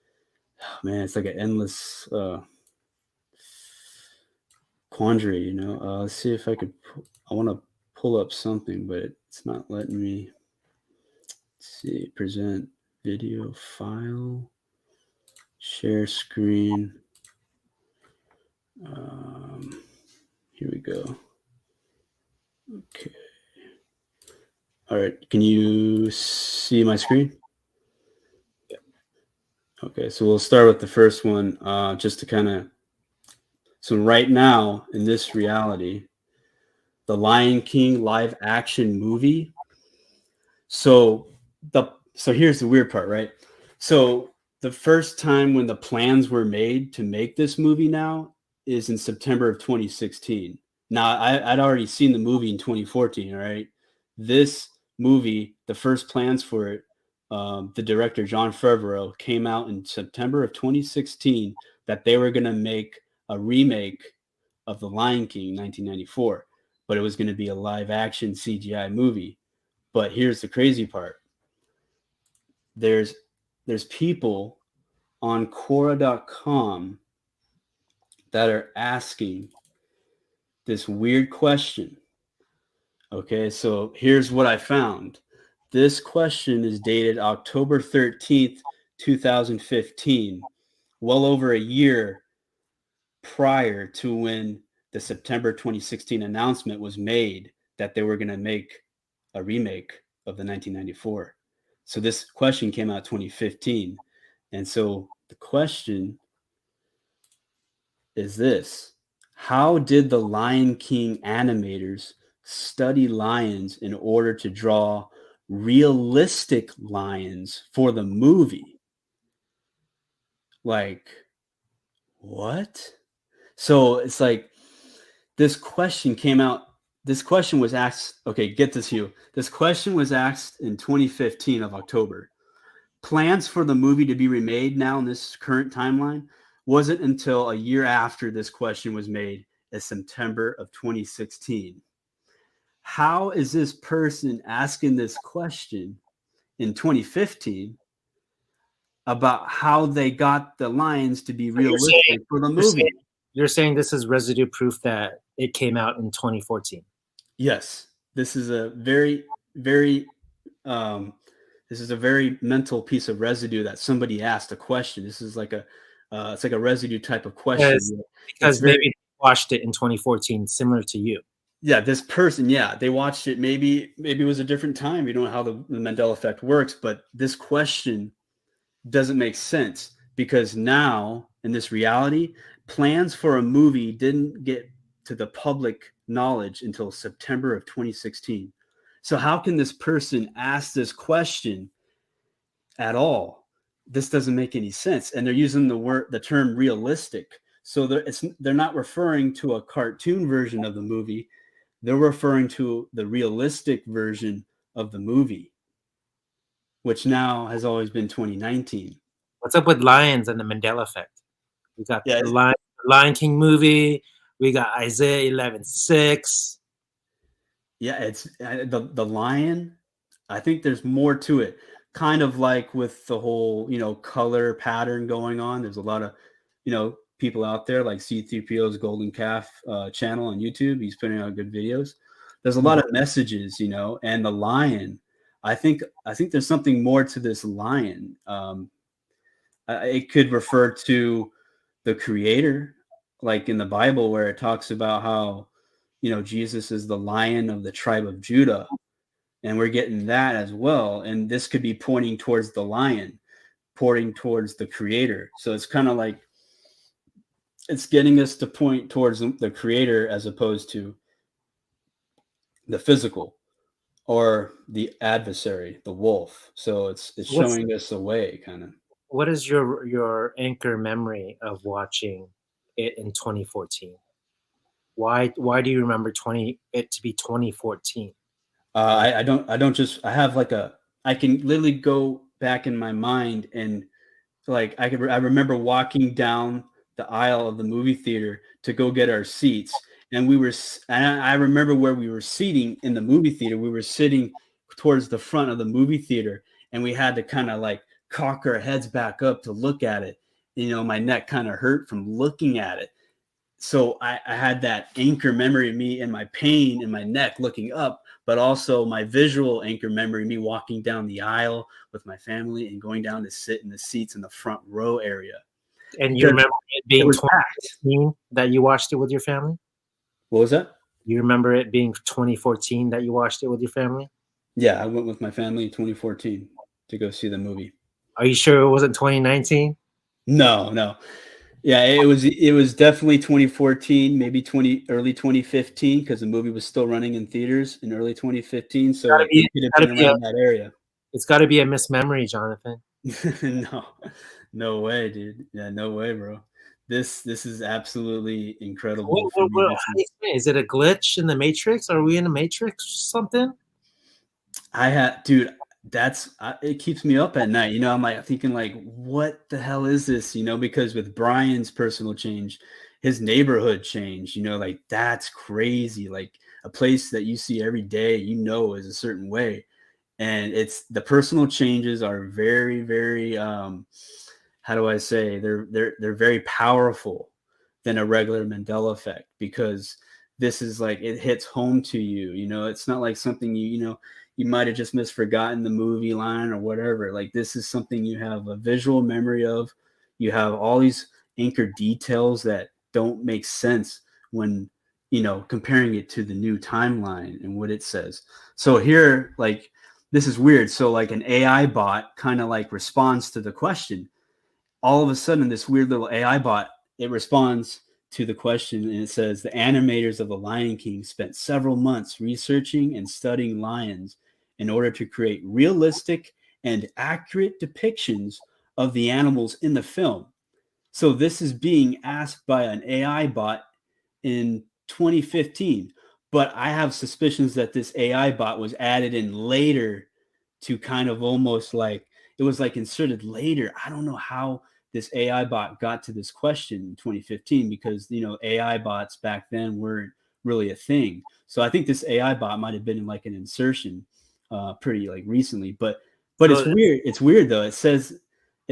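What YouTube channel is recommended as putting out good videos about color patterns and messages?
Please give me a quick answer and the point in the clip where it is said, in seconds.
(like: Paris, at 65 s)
C3PO's Golden Calf, at 227 s.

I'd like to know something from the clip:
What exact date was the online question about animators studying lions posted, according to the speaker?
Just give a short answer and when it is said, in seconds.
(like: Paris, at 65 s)
October 13, 2015, at 87 s.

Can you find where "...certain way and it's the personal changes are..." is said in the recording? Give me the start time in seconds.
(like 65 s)
368 s.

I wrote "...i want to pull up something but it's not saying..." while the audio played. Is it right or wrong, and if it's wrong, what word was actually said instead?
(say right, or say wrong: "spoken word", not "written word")
wrong: "letting", not "saying".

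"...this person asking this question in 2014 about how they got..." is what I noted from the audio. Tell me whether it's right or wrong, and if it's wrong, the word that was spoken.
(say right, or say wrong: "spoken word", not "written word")
wrong: "2015", not "2014".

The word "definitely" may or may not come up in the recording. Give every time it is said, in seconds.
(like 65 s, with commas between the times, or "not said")
332 s.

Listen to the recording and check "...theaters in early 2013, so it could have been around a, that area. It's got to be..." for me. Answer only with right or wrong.
wrong.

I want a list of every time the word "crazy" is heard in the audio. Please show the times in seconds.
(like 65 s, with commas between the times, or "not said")
70 s, 365 s.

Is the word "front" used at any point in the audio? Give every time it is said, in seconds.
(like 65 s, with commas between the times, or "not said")
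295 s, 314 s.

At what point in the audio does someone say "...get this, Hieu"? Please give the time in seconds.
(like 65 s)
128 s.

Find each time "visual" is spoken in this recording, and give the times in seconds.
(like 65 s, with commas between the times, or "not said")
309 s, 388 s.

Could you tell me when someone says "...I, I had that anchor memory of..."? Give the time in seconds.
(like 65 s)
304 s.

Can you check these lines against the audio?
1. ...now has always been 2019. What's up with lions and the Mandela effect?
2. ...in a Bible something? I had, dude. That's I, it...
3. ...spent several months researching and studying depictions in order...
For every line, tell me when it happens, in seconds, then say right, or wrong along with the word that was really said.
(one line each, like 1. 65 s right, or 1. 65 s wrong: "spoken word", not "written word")
1. 207 s right
2. 352 s wrong: "Matrix", not "Bible"
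3. 411 s wrong: "lions", not "depictions".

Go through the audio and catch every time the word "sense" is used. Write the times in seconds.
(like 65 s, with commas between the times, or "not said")
179 s, 194 s, 393 s.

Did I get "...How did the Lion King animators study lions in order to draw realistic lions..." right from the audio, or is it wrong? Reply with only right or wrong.
right.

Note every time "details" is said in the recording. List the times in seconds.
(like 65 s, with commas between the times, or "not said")
391 s.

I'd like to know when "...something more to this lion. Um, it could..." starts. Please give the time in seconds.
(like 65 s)
236 s.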